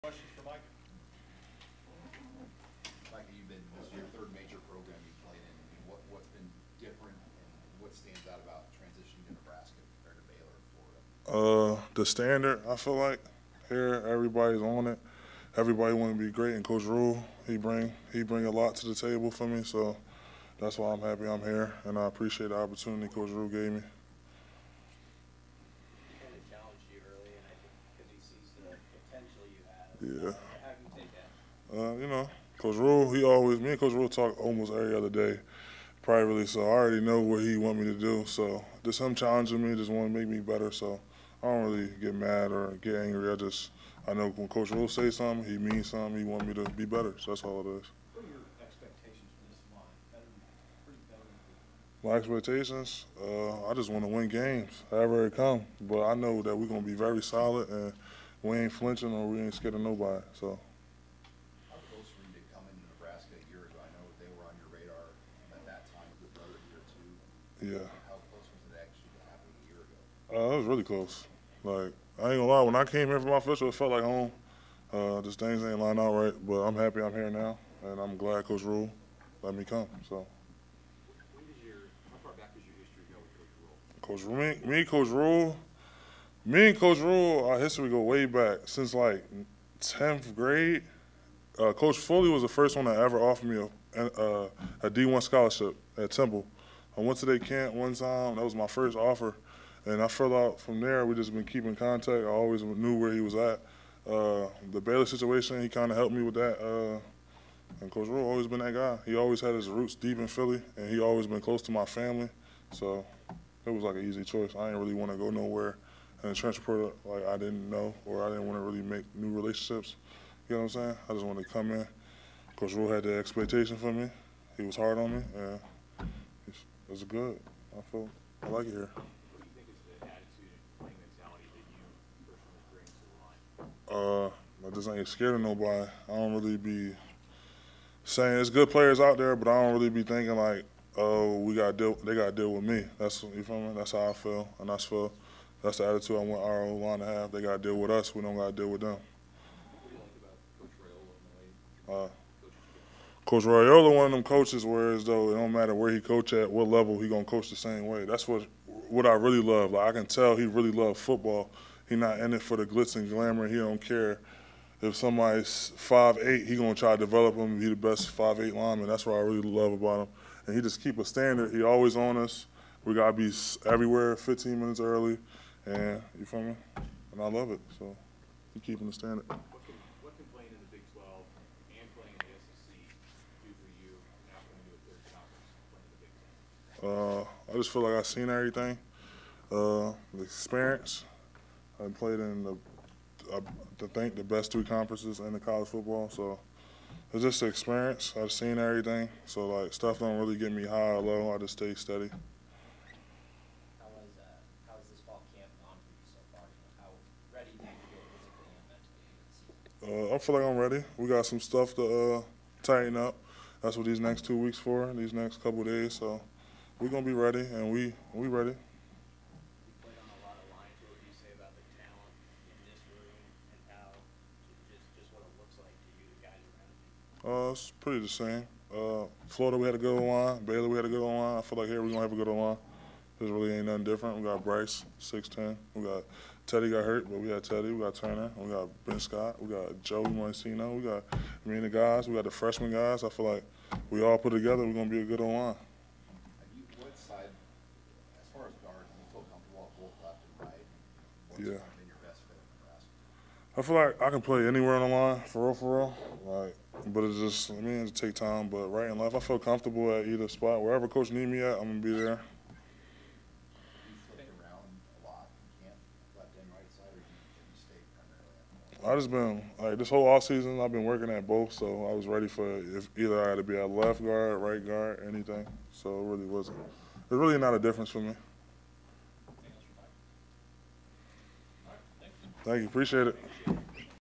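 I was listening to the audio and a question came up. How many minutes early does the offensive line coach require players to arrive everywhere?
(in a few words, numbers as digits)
15 minutes.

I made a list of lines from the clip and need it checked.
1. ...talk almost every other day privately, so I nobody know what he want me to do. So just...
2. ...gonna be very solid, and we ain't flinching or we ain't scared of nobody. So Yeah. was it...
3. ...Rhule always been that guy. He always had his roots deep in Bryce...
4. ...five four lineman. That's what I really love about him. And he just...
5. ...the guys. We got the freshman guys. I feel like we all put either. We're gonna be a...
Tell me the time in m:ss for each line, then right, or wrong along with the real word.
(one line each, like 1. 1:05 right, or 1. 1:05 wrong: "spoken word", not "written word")
1. 0:34 wrong: "already", not "nobody"
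2. 0:56 right
3. 1:48 wrong: "Philly", not "Bryce"
4. 2:48 wrong: "eight", not "four"
5. 4:01 wrong: "together", not "either".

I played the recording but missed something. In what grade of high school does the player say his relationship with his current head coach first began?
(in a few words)
10th grade.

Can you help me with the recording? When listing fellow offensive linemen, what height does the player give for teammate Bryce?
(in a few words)
6'10".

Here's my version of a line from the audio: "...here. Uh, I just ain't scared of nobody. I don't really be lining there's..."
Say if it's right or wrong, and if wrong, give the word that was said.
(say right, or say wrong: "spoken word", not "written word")
wrong: "saying", not "lining".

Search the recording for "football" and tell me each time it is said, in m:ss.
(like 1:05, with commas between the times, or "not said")
2:40, 3:15.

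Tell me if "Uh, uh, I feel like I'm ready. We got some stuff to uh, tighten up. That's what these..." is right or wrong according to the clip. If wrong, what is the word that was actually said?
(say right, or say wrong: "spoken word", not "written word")
right.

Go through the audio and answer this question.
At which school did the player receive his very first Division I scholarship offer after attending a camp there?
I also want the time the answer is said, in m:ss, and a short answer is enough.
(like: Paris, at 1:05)
Temple, at 1:36.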